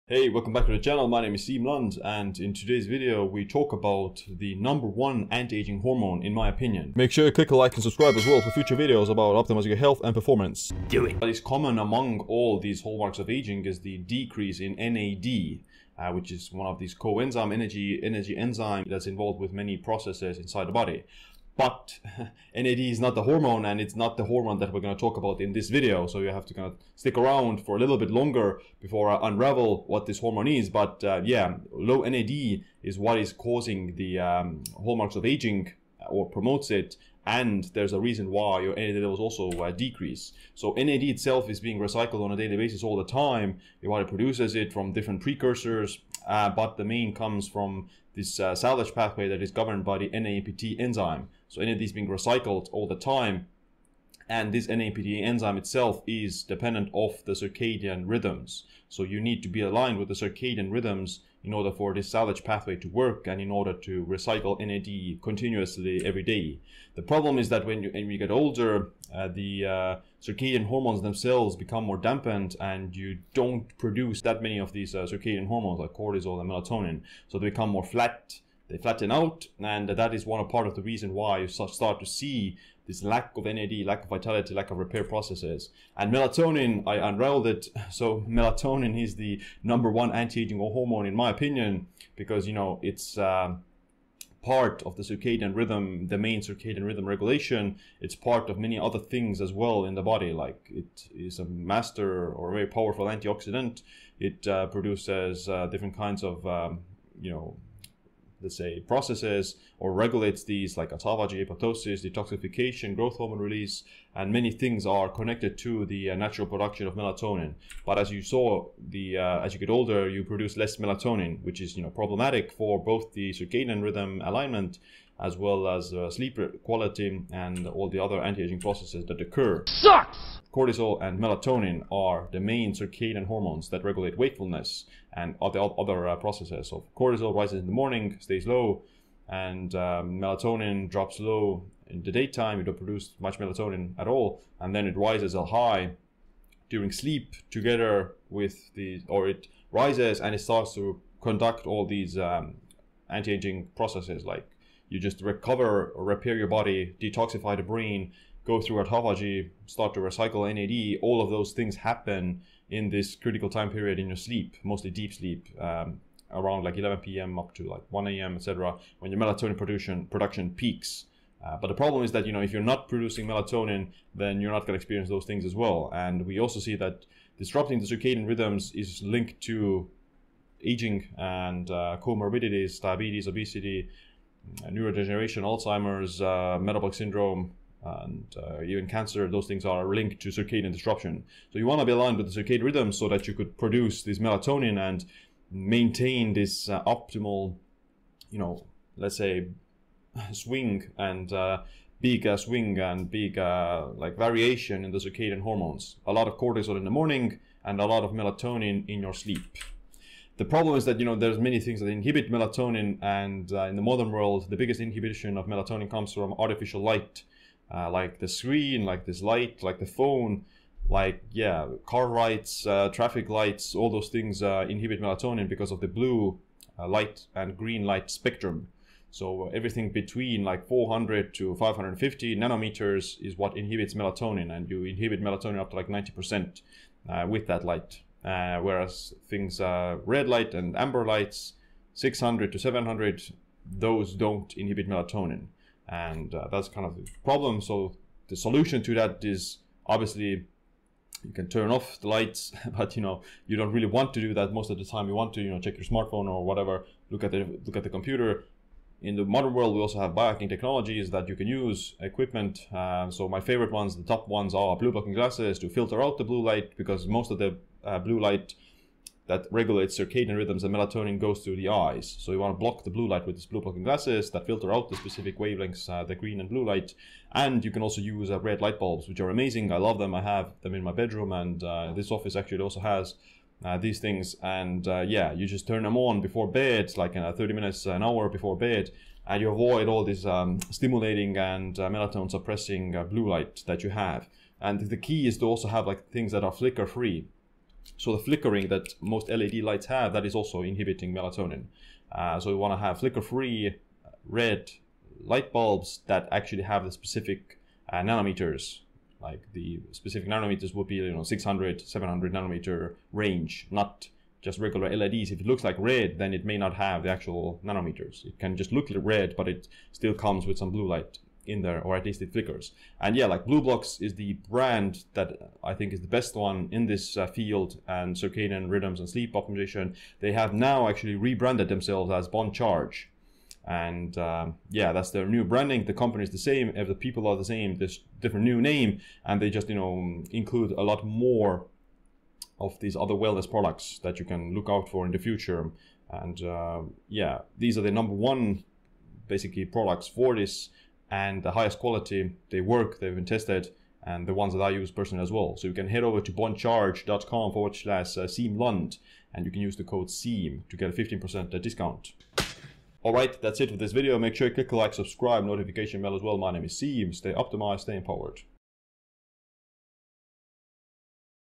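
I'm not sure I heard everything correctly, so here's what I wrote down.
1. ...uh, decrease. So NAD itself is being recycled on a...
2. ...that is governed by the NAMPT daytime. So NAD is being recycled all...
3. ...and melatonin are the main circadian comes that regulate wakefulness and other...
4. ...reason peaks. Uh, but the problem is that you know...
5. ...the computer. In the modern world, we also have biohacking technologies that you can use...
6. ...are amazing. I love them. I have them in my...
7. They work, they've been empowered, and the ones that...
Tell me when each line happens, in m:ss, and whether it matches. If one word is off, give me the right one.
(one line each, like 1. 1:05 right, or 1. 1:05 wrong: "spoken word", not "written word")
1. 0:39 right
2. 0:49 wrong: "enzyme", not "daytime"
3. 2:11 wrong: "hormones", not "comes"
4. 2:50 wrong: "production", not "reason"
5. 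4:17 right
6. 4:39 right
7. 5:52 wrong: "tested", not "empowered".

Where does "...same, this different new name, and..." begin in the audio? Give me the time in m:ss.
5:37.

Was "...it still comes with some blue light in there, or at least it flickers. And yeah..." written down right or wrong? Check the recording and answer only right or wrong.
right.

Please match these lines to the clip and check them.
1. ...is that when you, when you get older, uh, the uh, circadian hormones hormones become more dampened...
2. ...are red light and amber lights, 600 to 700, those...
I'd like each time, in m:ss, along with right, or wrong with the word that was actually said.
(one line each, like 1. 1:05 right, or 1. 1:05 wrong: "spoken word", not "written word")
1. 1:07 wrong: "themselves", not "hormones"
2. 3:59 right.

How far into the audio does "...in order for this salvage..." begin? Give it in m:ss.
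1:01.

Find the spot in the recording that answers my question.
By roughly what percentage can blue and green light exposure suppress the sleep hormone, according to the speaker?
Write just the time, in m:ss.
3:55.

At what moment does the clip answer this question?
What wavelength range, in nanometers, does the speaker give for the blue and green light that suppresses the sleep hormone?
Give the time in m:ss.
3:50.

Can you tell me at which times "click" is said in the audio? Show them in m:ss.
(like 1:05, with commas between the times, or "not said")
0:07, 6:04.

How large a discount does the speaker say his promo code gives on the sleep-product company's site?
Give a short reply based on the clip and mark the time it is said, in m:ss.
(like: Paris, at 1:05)
15%, at 6:00.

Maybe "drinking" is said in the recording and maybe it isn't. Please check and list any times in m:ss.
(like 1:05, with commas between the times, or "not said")
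not said.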